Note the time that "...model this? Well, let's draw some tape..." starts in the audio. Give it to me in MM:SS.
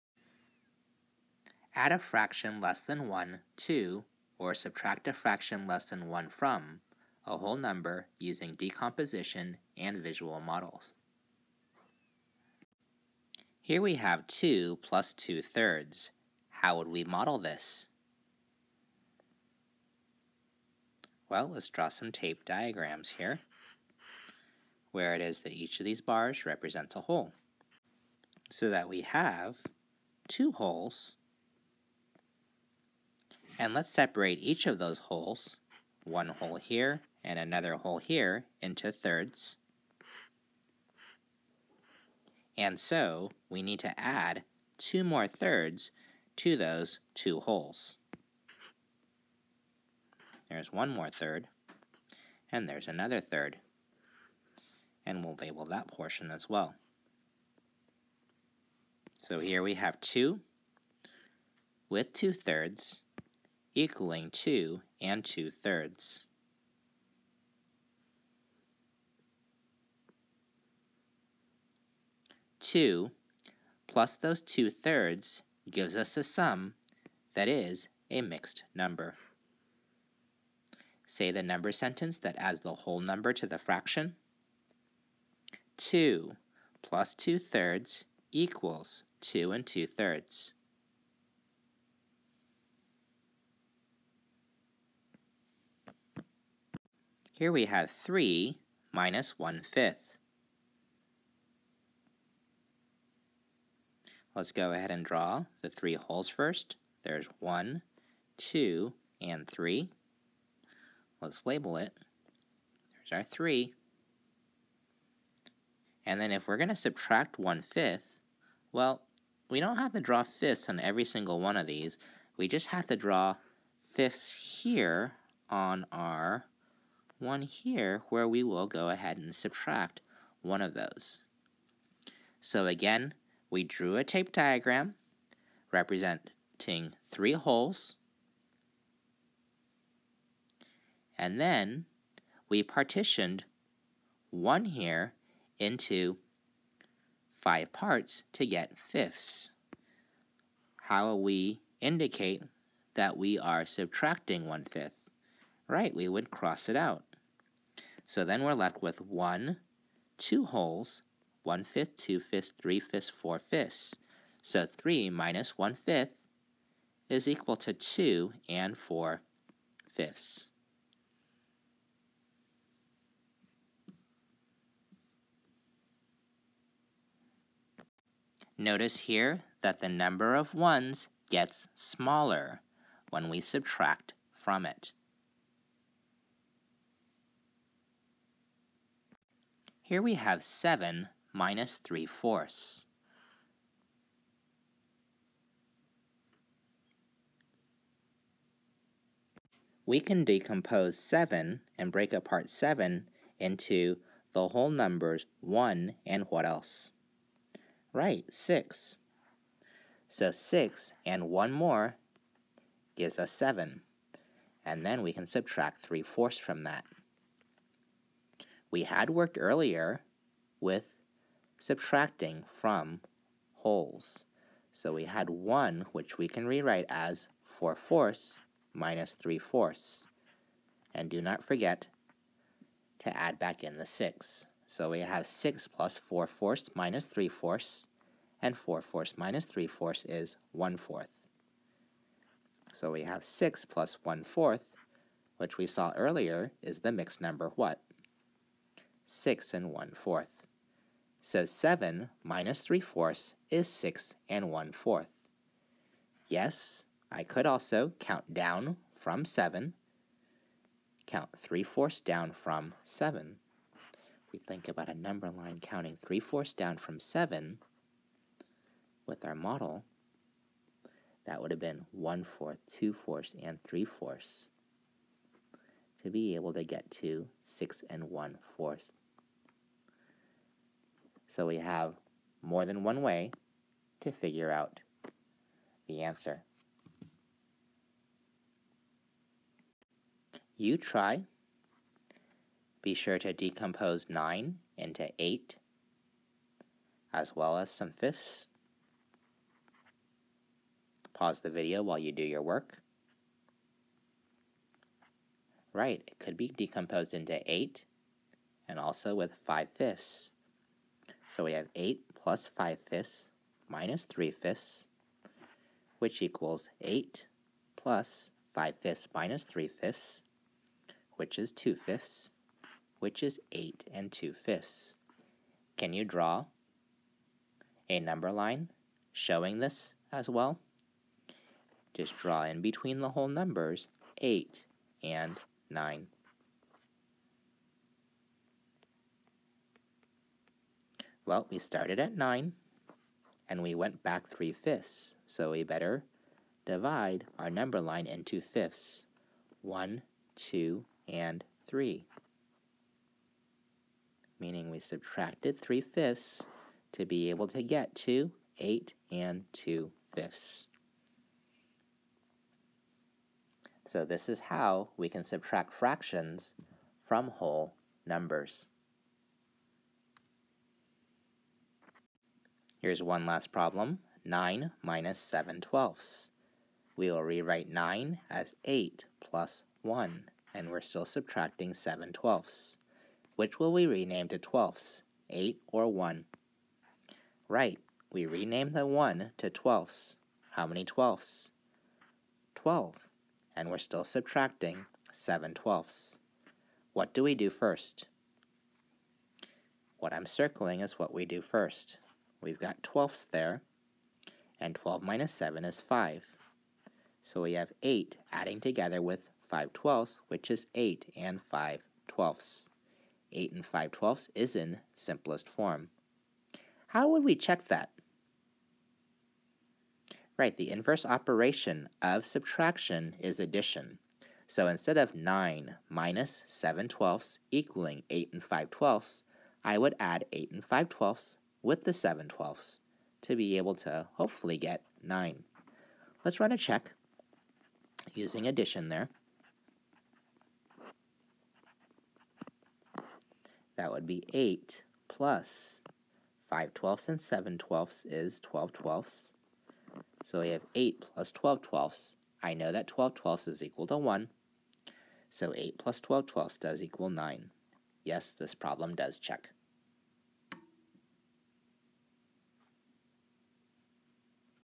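00:17.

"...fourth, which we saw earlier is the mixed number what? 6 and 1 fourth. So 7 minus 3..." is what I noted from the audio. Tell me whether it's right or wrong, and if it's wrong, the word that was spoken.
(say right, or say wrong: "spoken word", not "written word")
right.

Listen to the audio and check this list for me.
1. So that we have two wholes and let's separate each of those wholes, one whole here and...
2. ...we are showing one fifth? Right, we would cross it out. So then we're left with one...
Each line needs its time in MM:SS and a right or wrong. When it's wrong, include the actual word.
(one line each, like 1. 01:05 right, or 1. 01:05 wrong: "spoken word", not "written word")
1. 00:28 right
2. 02:33 wrong: "subtracting", not "showing".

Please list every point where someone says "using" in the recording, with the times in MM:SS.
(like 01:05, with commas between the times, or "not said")
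00:08, 07:18.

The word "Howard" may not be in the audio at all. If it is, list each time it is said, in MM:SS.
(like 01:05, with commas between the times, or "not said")
not said.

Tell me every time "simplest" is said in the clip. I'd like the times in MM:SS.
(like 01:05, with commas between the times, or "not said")
06:54.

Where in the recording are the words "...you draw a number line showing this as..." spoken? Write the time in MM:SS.
05:25.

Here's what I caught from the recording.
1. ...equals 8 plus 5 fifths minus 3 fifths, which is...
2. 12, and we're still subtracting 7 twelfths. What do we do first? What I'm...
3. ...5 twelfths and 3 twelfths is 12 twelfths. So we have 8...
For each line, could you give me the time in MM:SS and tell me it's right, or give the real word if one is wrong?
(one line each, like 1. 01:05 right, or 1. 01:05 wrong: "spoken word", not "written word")
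1. 05:16 right
2. 06:32 right
3. 07:26 wrong: "7", not "3".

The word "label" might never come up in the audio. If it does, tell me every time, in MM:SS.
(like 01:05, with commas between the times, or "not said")
00:55, 01:51.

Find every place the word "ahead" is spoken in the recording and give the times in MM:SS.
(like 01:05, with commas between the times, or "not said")
01:44, 02:08.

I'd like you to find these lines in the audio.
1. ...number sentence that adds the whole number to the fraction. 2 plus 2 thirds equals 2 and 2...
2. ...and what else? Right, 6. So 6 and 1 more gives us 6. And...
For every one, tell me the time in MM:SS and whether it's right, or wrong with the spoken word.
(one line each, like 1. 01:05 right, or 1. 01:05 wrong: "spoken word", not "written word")
1. 01:21 right
2. 03:26 wrong: "7", not "6".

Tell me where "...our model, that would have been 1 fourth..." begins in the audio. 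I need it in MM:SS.
04:29.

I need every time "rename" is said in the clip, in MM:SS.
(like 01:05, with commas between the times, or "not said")
06:23, 06:28.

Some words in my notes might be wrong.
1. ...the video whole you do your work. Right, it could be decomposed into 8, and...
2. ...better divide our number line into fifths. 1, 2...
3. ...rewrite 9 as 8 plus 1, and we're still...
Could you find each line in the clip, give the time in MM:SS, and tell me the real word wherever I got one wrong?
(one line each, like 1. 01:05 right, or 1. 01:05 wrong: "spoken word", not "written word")
1. 05:01 wrong: "while", not "whole"
2. 05:45 right
3. 06:17 right.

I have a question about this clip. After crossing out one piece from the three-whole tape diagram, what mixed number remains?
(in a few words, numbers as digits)
2 and 4 fifths.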